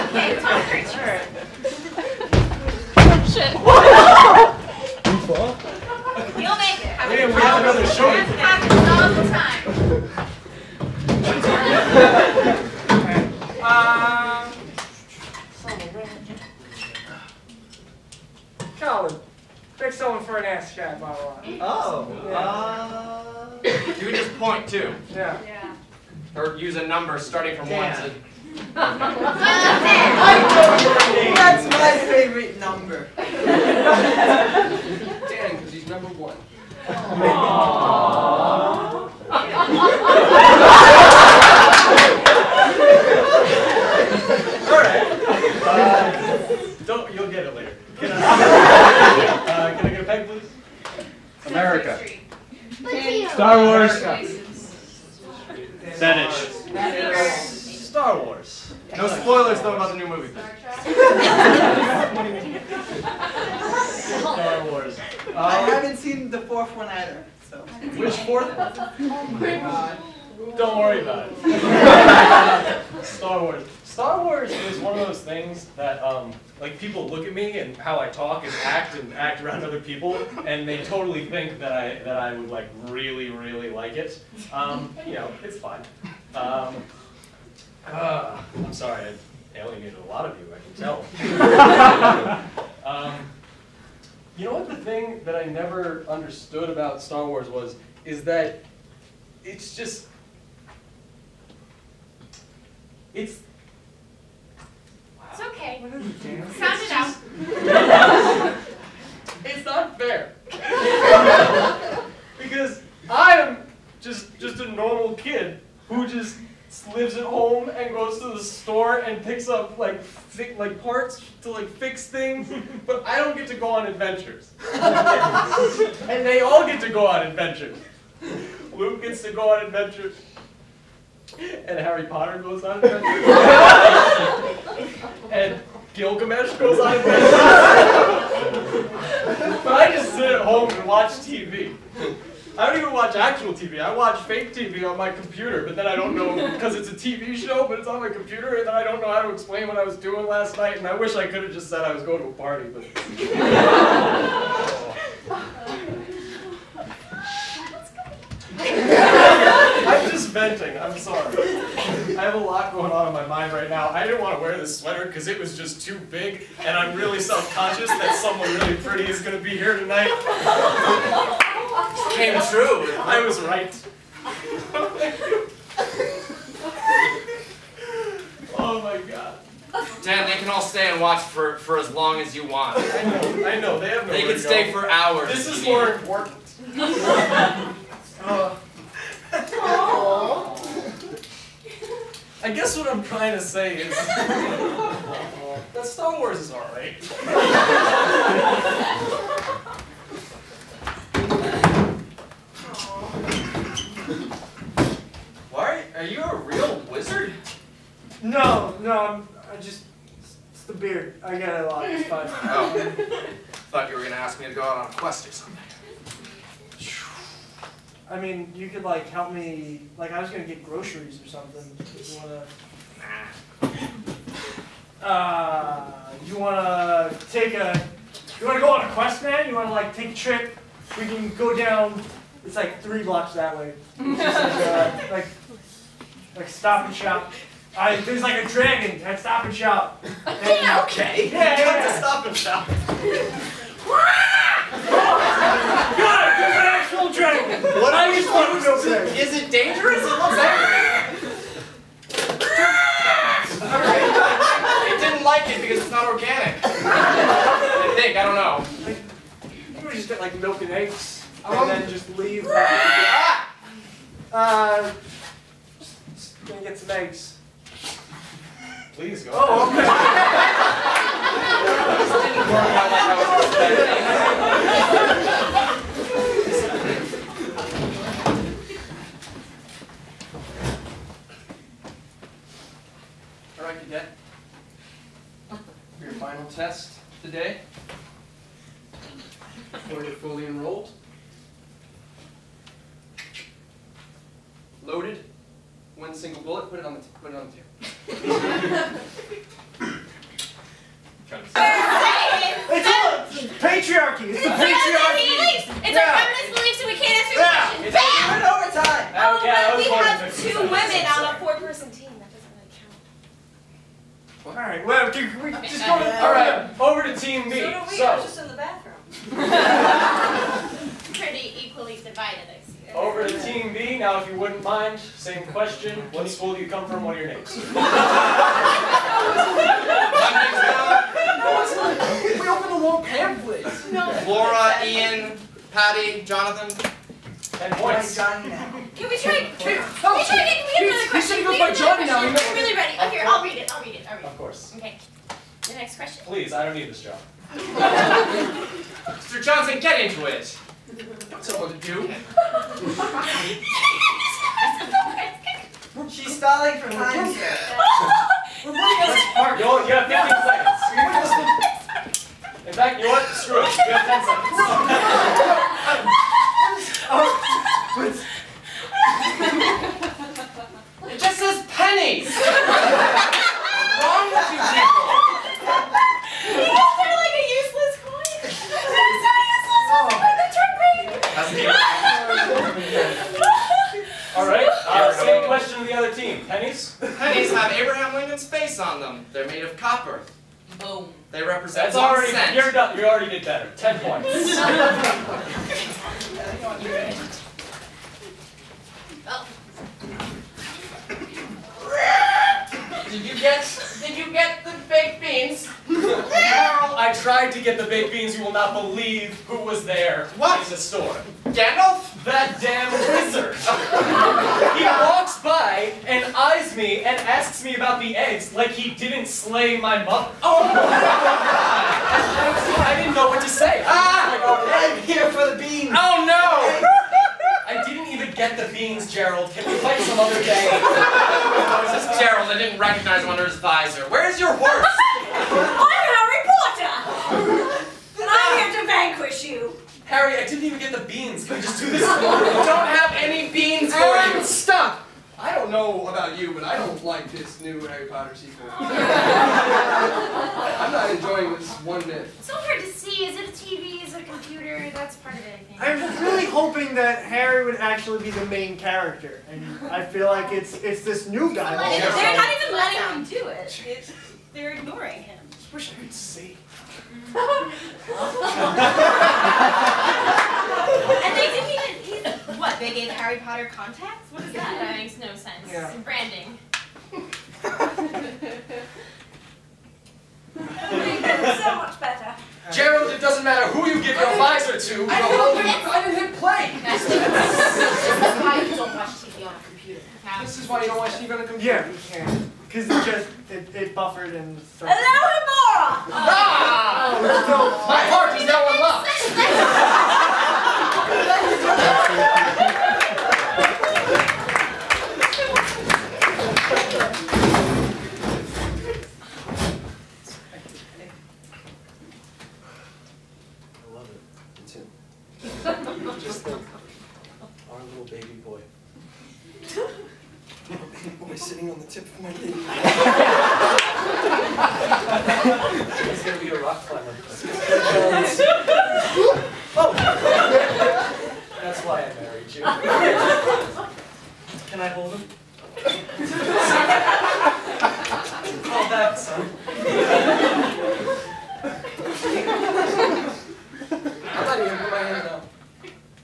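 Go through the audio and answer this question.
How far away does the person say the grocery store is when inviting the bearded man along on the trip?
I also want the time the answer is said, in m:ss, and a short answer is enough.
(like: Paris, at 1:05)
three blocks, at 3:52.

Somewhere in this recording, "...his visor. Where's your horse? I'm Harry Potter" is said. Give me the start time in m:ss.
7:13.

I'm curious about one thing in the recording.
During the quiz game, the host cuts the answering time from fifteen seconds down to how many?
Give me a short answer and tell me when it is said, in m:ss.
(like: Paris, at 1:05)
10 seconds, at 6:04.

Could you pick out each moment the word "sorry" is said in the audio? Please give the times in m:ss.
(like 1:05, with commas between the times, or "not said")
1:28, 2:40.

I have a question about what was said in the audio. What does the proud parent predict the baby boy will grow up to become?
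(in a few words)
rock climber.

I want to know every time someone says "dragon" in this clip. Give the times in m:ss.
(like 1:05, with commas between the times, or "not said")
3:58, 4:07.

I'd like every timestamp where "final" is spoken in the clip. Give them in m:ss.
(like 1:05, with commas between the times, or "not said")
4:46.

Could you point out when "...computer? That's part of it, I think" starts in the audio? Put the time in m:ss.
7:34.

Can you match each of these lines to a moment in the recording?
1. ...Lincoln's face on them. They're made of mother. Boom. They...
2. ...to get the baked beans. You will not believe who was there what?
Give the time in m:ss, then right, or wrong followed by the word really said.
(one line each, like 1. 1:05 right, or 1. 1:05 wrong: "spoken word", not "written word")
1. 6:28 wrong: "copper", not "mother"
2. 6:47 right.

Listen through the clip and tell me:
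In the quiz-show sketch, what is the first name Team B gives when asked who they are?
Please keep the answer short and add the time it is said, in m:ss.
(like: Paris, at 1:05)
Laura, at 5:34.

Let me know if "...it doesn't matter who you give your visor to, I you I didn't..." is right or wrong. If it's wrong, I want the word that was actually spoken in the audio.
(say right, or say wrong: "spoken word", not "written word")
right.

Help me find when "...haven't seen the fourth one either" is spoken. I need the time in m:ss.
1:05.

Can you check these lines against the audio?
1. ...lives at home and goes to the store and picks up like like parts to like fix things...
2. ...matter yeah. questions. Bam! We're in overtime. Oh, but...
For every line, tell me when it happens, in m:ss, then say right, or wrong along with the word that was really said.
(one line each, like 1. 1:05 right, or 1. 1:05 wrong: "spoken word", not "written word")
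1. 1:56 right
2. 5:07 wrong: "answer", not "matter".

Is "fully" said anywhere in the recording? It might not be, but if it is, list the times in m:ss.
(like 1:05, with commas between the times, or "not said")
4:50.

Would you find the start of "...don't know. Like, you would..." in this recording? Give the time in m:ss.
4:18.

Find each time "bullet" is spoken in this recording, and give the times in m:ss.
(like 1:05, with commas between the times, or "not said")
4:56.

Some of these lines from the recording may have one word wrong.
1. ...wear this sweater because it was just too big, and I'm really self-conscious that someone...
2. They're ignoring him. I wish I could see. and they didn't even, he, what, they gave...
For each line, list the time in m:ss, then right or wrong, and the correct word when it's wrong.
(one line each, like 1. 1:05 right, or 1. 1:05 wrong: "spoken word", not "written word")
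1. 2:44 right
2. 7:44 right.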